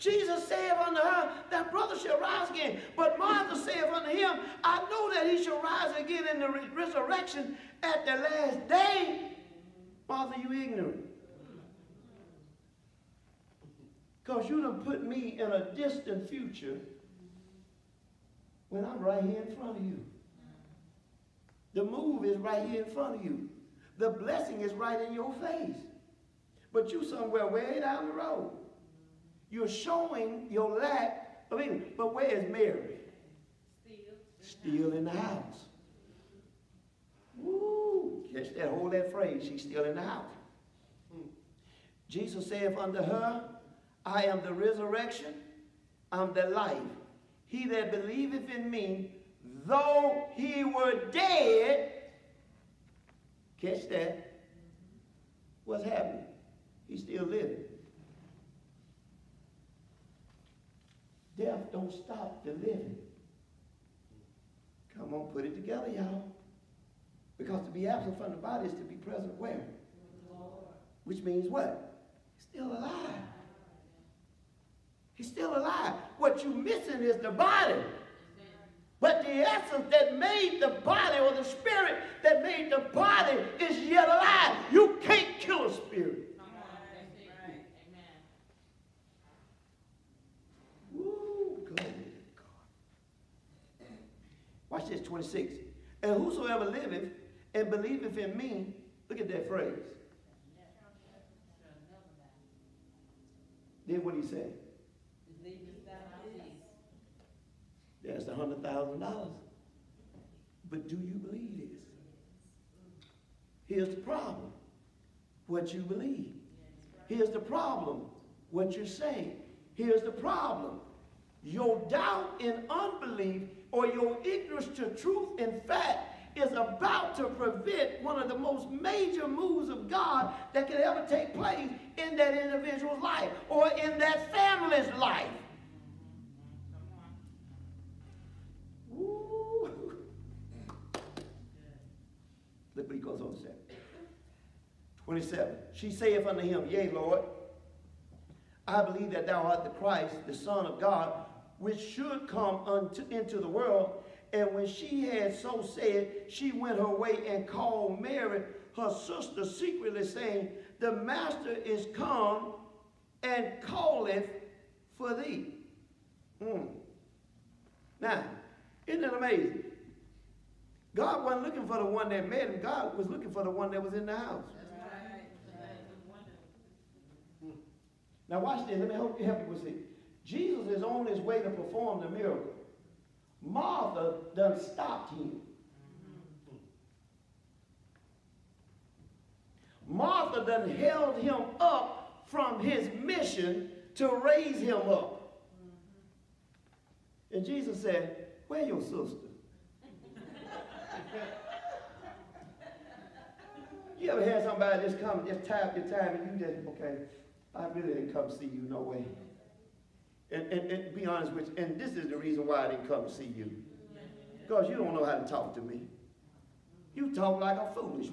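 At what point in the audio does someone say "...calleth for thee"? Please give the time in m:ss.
2:43.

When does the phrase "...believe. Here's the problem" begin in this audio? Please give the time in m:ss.
1:55.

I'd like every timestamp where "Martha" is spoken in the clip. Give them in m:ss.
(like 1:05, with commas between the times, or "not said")
0:03, 0:10, 3:03, 3:09.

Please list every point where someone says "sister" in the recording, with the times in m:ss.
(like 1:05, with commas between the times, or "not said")
2:38, 3:18.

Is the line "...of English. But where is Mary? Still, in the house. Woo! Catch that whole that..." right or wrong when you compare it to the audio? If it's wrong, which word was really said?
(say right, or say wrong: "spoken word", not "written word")
right.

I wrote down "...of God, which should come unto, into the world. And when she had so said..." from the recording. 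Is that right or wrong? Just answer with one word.
right.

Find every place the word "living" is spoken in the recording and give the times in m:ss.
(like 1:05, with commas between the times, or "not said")
0:57, 1:02.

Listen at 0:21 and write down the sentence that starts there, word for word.
The move is right here in front of you.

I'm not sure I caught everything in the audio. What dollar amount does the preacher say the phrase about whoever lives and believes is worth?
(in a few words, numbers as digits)
$100,000.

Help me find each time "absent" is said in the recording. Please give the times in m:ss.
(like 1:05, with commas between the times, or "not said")
1:07.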